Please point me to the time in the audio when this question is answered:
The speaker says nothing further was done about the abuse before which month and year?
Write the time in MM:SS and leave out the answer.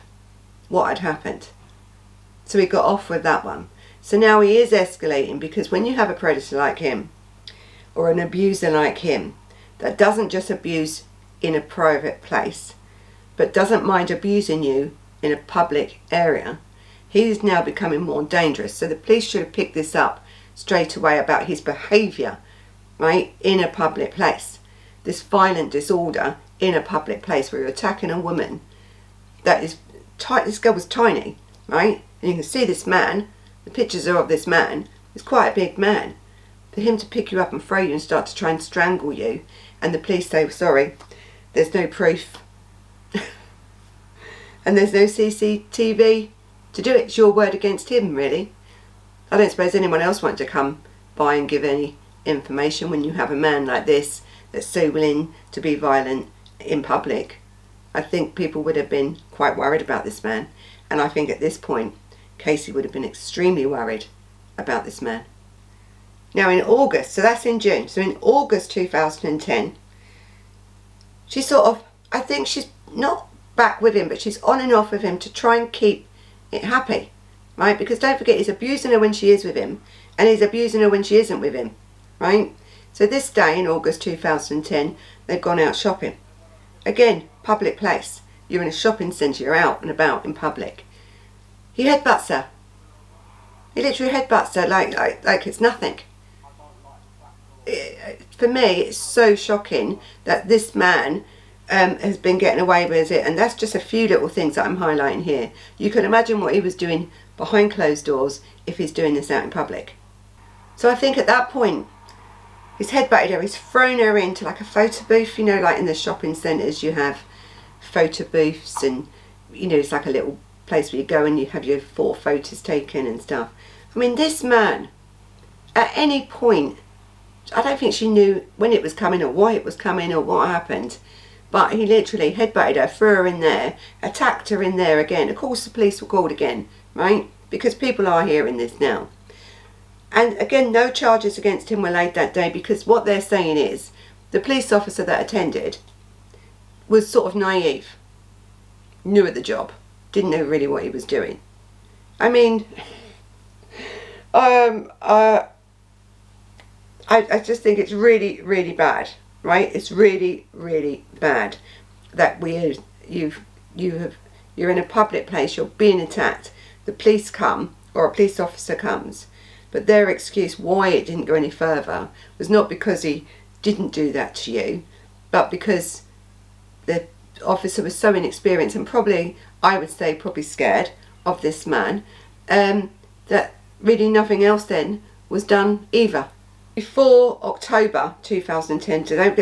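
03:07.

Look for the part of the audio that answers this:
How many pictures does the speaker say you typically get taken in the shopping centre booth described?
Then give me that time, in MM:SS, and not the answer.
02:01.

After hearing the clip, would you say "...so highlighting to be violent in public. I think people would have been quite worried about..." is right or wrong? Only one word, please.
wrong.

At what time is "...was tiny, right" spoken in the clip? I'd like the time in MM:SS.
00:30.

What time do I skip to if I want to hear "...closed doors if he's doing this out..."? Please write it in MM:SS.
01:47.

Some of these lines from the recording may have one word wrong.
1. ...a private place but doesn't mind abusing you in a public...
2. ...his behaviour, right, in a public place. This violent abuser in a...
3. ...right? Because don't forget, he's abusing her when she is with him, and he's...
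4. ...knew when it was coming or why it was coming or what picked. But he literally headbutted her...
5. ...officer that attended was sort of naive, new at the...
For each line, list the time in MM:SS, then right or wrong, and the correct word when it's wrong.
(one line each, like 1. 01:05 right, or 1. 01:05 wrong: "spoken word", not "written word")
1. 00:11 right
2. 00:21 wrong: "disorder", not "abuser"
3. 01:17 right
4. 02:08 wrong: "happened", not "picked"
5. 02:24 right.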